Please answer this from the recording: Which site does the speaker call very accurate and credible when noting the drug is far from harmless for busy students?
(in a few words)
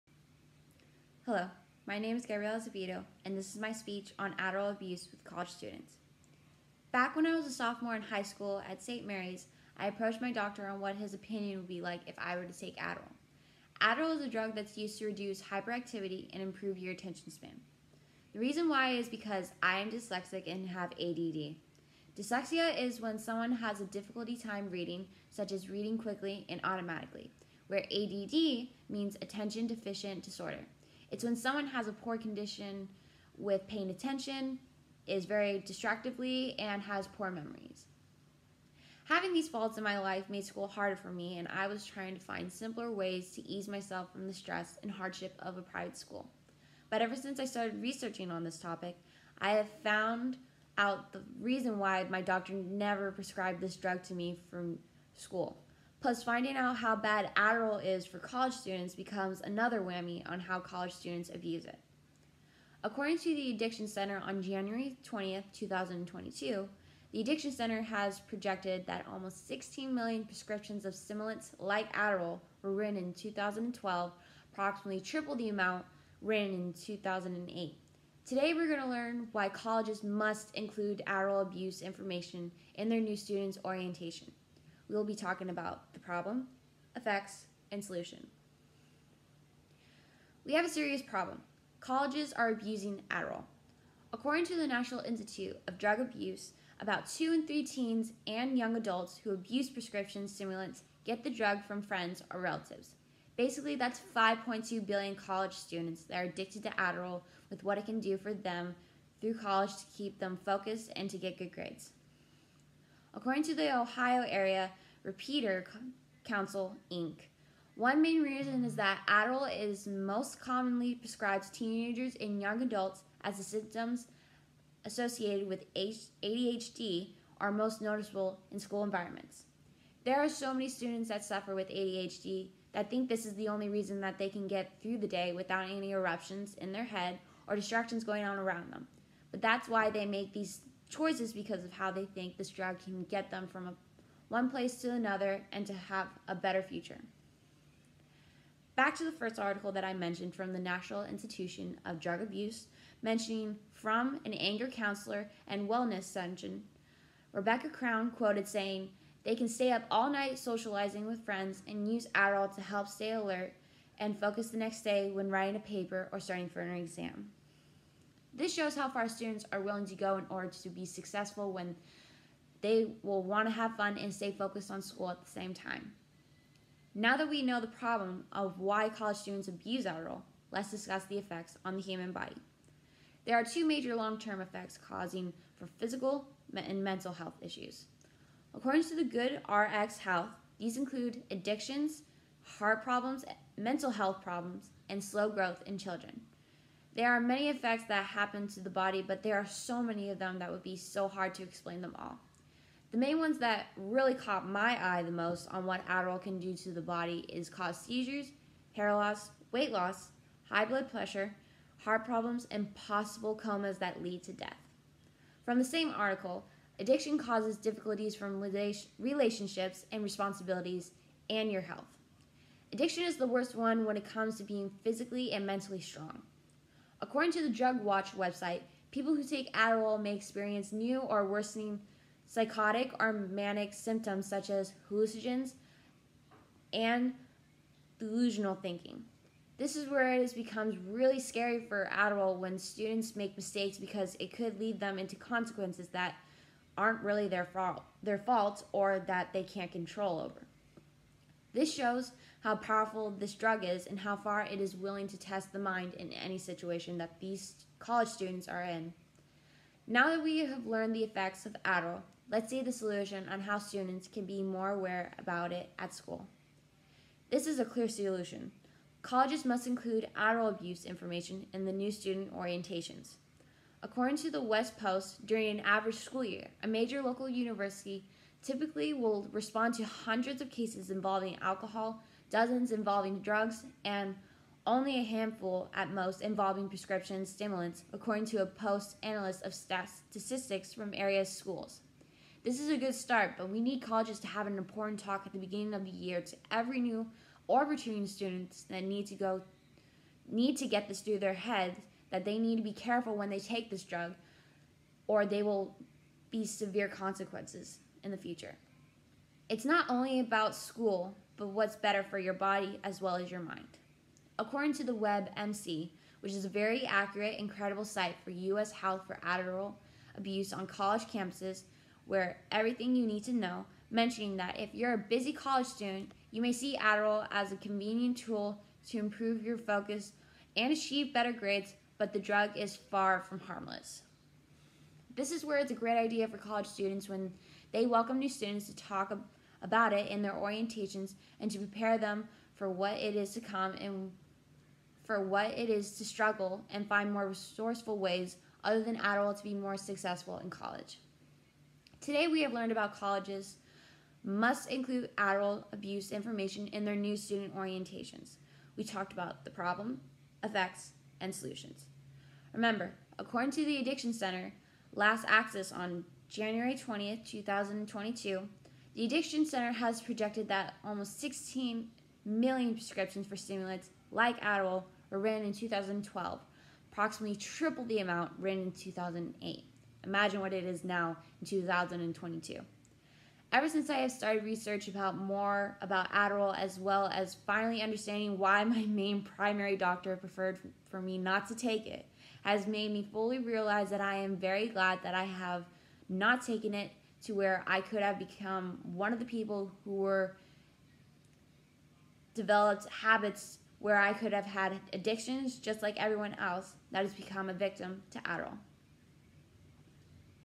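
WebMD.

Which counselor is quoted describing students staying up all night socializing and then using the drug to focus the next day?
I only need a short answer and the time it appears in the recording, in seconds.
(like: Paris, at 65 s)
Rebecca Crown, at 157 s.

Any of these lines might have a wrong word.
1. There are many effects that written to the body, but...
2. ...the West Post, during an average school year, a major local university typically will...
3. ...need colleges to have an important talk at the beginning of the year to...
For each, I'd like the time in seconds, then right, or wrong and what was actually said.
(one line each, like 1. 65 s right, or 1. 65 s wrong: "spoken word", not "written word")
1. 196 s wrong: "happen", not "written"
2. 274 s right
3. 293 s right.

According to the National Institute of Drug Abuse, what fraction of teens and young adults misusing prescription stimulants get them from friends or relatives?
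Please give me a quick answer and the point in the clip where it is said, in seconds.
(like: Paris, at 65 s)
2 in 3, at 97 s.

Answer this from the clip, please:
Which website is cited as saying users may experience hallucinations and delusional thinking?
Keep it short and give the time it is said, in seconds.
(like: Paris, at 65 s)
Drugwatch, at 227 s.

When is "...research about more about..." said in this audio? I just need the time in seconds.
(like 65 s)
384 s.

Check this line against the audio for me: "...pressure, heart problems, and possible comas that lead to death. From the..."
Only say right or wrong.
right.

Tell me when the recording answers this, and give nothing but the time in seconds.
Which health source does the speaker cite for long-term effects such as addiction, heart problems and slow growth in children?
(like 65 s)
189 s.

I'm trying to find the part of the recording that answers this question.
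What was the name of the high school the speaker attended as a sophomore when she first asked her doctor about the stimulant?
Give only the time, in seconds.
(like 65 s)
8 s.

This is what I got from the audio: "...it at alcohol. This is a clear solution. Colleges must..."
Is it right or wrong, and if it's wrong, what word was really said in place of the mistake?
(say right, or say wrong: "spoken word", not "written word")
wrong: "school", not "alcohol".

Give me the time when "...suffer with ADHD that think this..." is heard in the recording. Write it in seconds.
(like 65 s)
131 s.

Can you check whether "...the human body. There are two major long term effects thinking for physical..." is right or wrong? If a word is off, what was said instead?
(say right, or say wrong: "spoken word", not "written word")
wrong: "causing", not "thinking".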